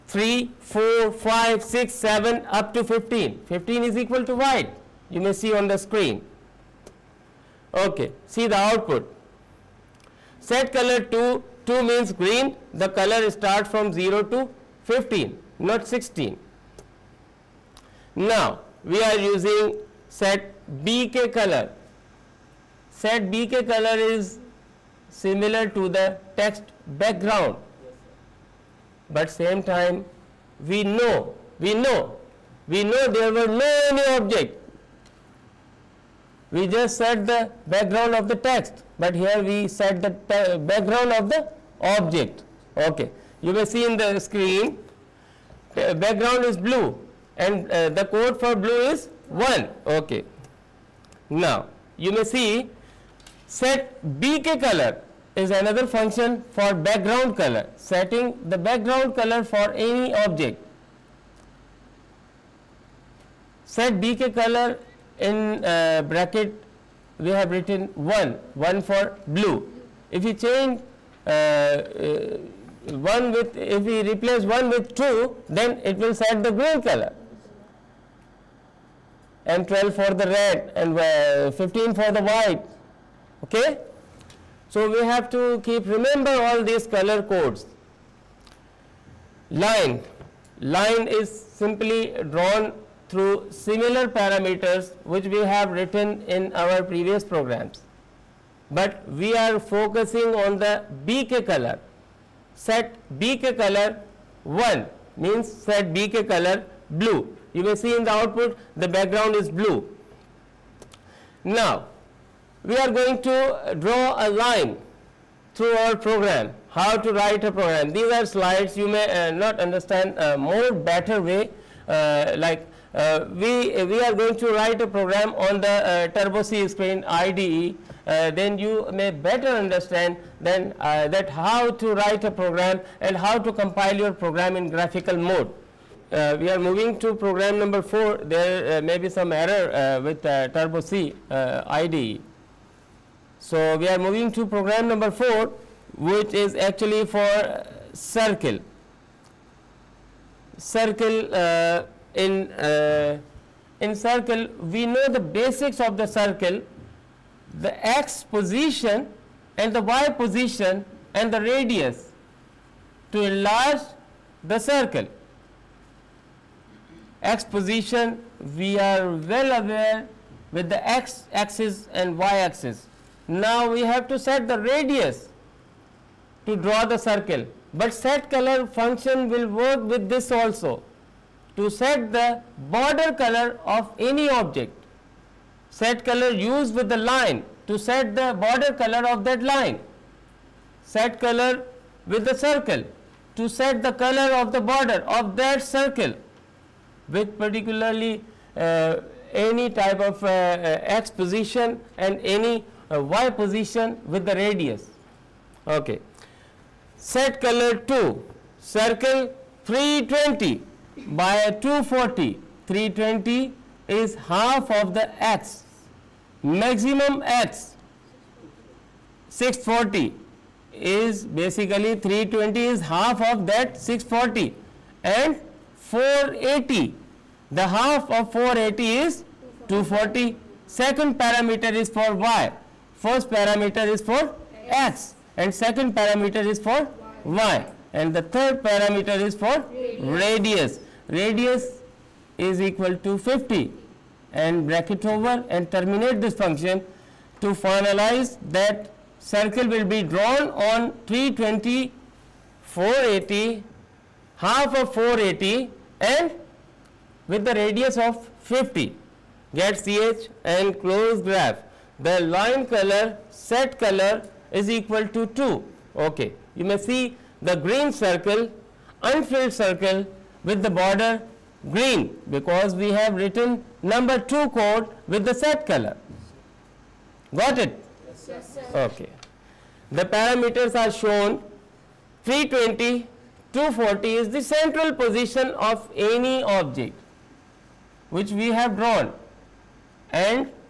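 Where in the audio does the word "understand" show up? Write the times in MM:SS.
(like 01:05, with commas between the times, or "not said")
01:59, 02:09.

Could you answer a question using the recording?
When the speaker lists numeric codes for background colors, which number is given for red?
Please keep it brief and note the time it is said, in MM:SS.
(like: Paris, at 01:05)
12, at 01:19.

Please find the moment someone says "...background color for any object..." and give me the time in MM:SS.
00:58.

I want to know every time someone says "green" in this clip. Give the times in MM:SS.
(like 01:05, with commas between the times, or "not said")
00:12, 01:16, 04:27, 04:31.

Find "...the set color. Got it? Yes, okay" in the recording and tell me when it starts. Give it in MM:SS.
04:35.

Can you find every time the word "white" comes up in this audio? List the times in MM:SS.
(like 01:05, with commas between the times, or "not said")
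00:04, 01:22.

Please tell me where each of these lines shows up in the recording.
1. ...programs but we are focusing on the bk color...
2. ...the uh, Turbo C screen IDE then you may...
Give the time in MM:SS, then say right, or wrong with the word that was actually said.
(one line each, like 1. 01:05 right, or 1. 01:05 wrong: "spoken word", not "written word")
1. 01:37 right
2. 02:05 right.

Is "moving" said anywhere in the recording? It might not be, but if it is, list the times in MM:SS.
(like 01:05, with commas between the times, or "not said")
02:16, 02:23.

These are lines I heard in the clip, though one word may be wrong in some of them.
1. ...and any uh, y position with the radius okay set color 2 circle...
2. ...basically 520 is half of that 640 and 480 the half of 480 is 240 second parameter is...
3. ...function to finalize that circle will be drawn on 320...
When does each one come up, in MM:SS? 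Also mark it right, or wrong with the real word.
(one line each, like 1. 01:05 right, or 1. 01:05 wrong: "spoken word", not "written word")
1. 03:21 right
2. 03:41 wrong: "320", not "520"
3. 04:06 right.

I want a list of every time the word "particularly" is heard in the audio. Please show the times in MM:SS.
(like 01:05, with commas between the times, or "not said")
03:17.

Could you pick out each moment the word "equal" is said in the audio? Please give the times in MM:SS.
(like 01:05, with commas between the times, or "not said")
00:04, 04:02, 04:24.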